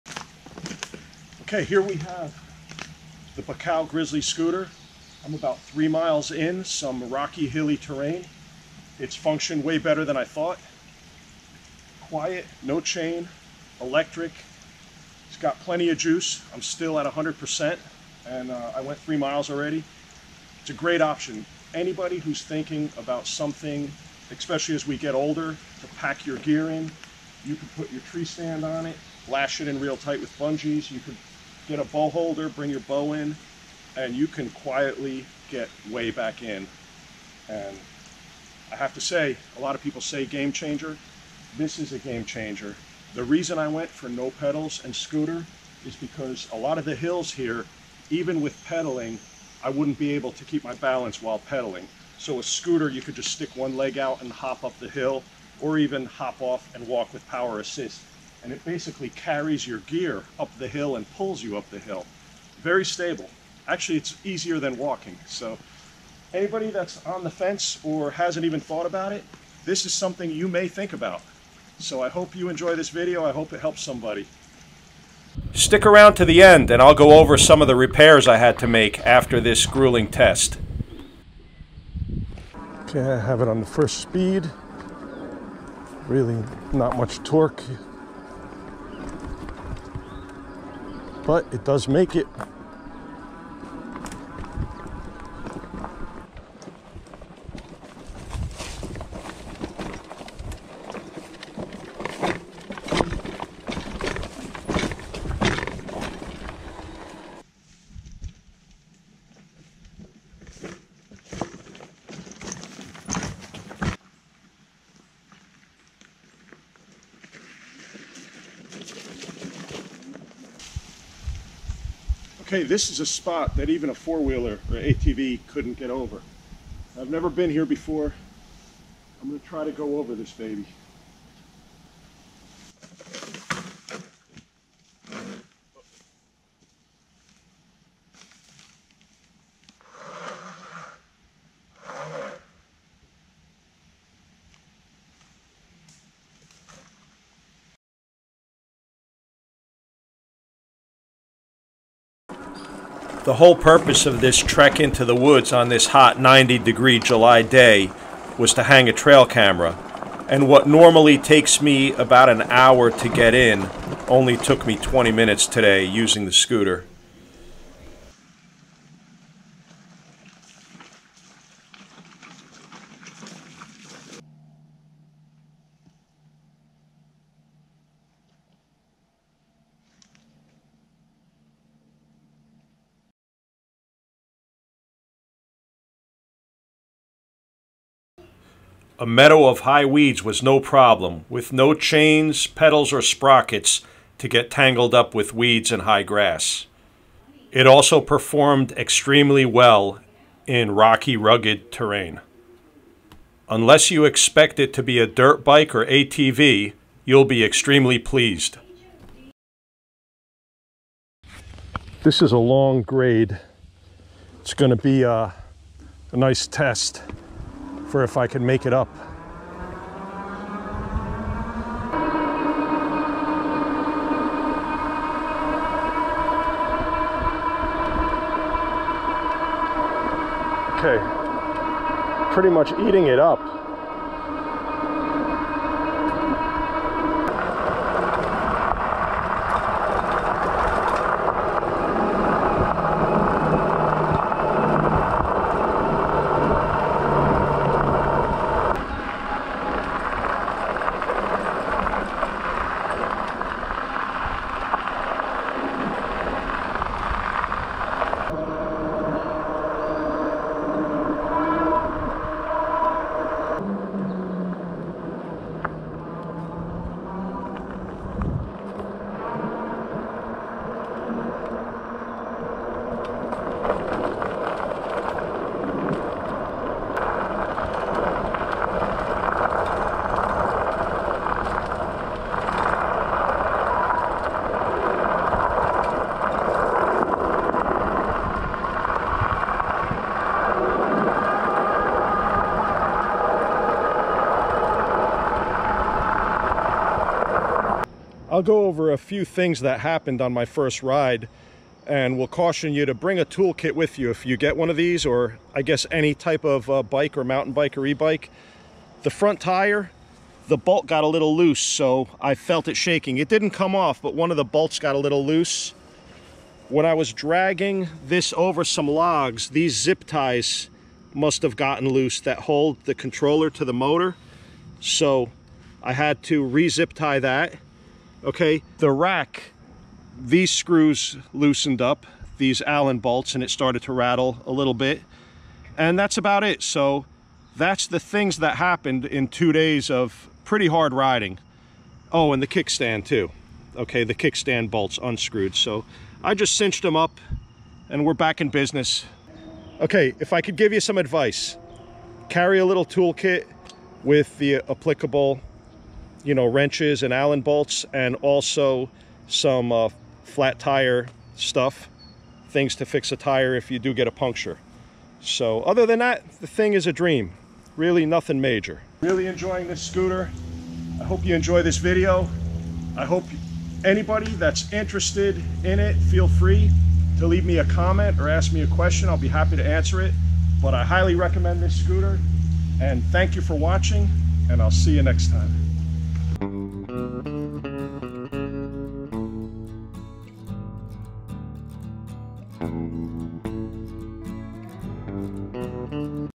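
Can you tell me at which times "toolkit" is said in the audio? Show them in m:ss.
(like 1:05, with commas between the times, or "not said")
5:03, 5:52.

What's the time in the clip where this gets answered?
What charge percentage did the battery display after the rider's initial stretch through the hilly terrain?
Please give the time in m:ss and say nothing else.
0:17.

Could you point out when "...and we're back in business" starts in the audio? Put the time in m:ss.
5:47.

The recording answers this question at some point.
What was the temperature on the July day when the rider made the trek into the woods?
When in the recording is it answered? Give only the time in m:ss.
2:36.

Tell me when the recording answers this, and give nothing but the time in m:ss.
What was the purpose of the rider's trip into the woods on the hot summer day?
2:38.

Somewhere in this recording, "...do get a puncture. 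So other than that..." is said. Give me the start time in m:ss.
6:03.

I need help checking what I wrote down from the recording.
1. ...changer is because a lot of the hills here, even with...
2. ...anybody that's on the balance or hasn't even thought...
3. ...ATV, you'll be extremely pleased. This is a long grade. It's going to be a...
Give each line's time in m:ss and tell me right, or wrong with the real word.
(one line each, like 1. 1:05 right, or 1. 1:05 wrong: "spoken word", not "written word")
1. 0:44 wrong: "scooter", not "changer"
2. 1:06 wrong: "fence", not "balance"
3. 3:25 right.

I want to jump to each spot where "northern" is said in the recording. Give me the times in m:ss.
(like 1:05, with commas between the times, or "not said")
not said.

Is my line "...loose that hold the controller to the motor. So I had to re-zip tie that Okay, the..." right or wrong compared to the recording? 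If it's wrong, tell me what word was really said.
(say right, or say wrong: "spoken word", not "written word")
right.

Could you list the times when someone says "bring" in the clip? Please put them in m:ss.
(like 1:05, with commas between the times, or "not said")
0:32, 5:02.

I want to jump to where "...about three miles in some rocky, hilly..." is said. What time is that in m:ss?
0:05.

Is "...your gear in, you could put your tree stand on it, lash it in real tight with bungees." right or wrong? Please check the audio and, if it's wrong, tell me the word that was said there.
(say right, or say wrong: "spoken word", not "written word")
right.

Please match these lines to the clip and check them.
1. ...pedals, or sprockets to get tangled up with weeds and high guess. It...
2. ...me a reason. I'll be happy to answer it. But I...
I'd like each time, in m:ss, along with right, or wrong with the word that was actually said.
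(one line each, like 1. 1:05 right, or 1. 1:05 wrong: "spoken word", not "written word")
1. 3:12 wrong: "grass", not "guess"
2. 6:18 wrong: "question", not "reason".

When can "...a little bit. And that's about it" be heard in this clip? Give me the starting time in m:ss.
5:34.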